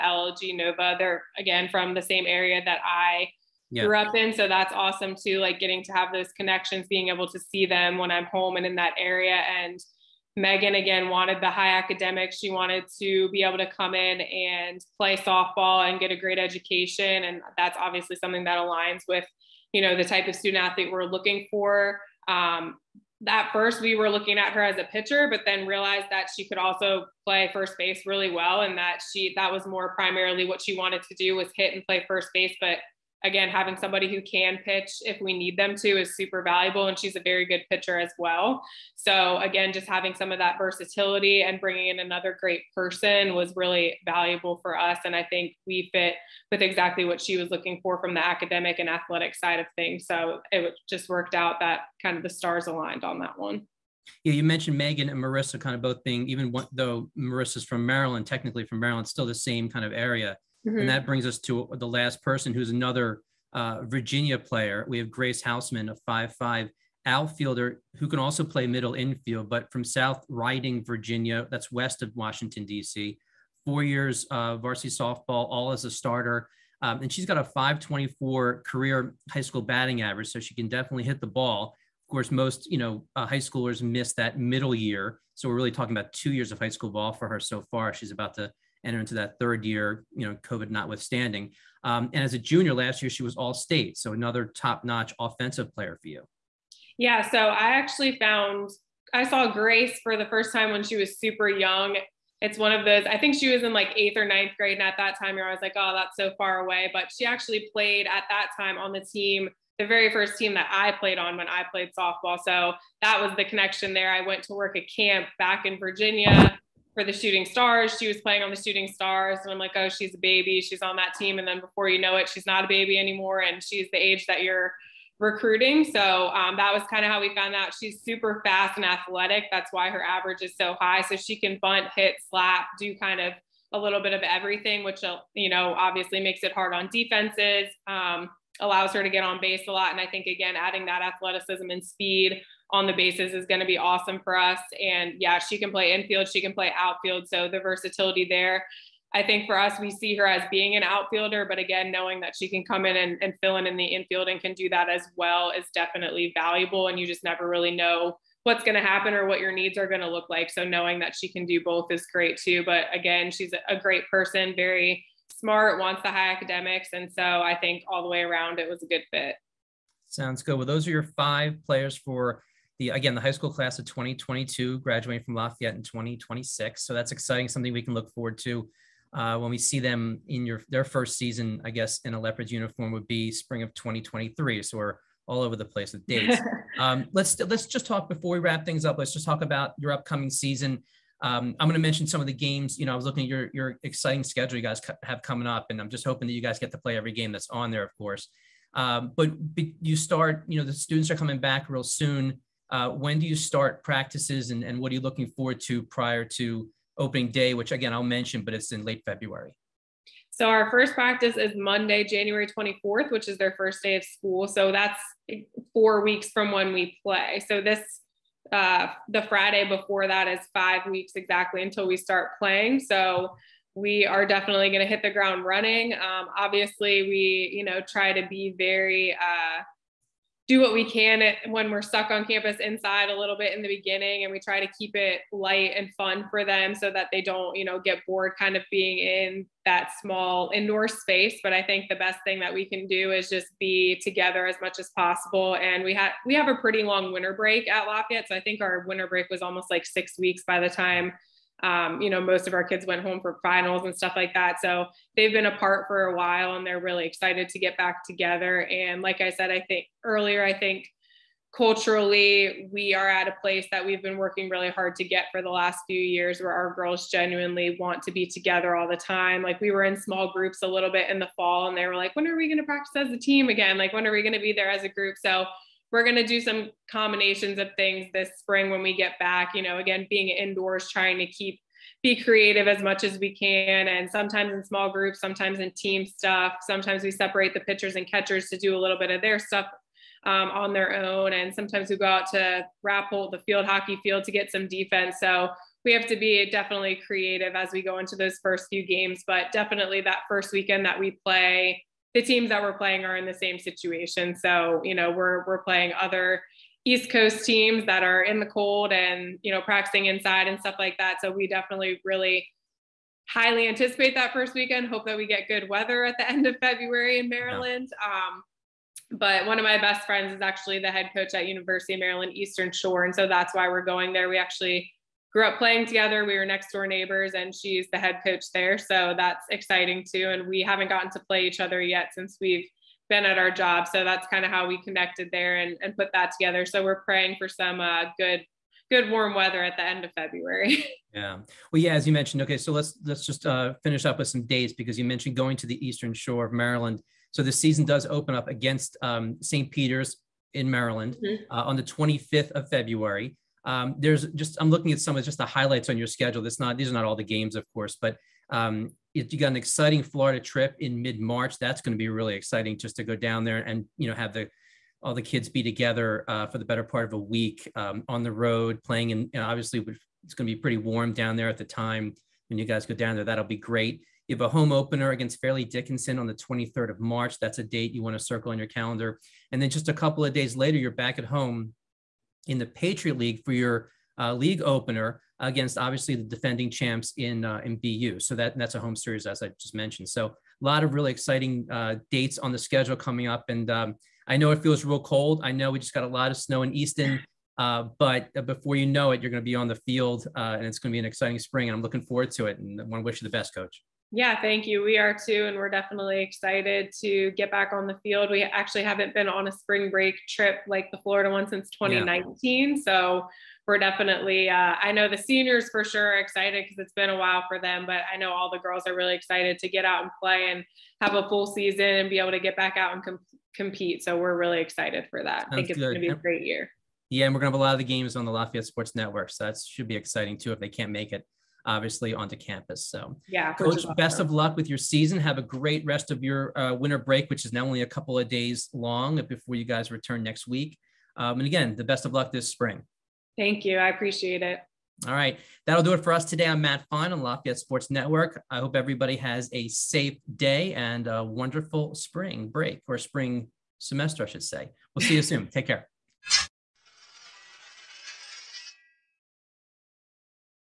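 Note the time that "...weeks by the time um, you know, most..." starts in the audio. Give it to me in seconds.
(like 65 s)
250 s.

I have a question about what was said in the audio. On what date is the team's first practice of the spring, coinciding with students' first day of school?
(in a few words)
January 24th.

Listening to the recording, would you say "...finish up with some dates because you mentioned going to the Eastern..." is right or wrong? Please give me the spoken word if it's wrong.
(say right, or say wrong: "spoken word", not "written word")
right.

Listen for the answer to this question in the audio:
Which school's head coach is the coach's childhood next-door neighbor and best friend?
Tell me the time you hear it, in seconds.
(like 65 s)
321 s.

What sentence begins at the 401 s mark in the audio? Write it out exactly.
And I'm looking forward to it.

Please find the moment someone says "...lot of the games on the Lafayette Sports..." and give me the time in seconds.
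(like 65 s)
427 s.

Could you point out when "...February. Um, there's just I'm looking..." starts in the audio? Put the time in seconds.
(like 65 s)
352 s.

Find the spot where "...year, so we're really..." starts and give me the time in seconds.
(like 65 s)
84 s.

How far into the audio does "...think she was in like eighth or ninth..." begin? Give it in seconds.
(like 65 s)
103 s.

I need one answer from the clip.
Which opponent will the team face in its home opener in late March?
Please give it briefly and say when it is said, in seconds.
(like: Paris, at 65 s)
Fairleigh Dickinson, at 375 s.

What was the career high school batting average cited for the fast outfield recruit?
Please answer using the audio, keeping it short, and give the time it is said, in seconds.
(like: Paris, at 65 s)
.524, at 77 s.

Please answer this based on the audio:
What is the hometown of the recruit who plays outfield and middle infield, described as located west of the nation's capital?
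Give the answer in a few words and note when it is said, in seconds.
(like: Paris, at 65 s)
South Riding, Virginia, at 69 s.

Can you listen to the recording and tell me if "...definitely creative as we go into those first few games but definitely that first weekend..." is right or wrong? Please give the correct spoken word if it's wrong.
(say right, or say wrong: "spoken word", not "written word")
right.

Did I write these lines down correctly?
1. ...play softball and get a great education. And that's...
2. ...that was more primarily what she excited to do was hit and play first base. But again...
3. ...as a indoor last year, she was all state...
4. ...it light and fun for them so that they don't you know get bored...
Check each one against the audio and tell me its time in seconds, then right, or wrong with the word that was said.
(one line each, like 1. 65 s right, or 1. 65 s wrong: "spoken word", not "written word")
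1. 14 s right
2. 29 s wrong: "wanted", not "excited"
3. 92 s wrong: "junior", not "indoor"
4. 234 s right.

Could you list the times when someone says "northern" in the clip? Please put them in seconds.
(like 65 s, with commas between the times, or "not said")
not said.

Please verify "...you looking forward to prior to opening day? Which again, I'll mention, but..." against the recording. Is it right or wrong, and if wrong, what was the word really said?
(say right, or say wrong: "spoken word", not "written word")
right.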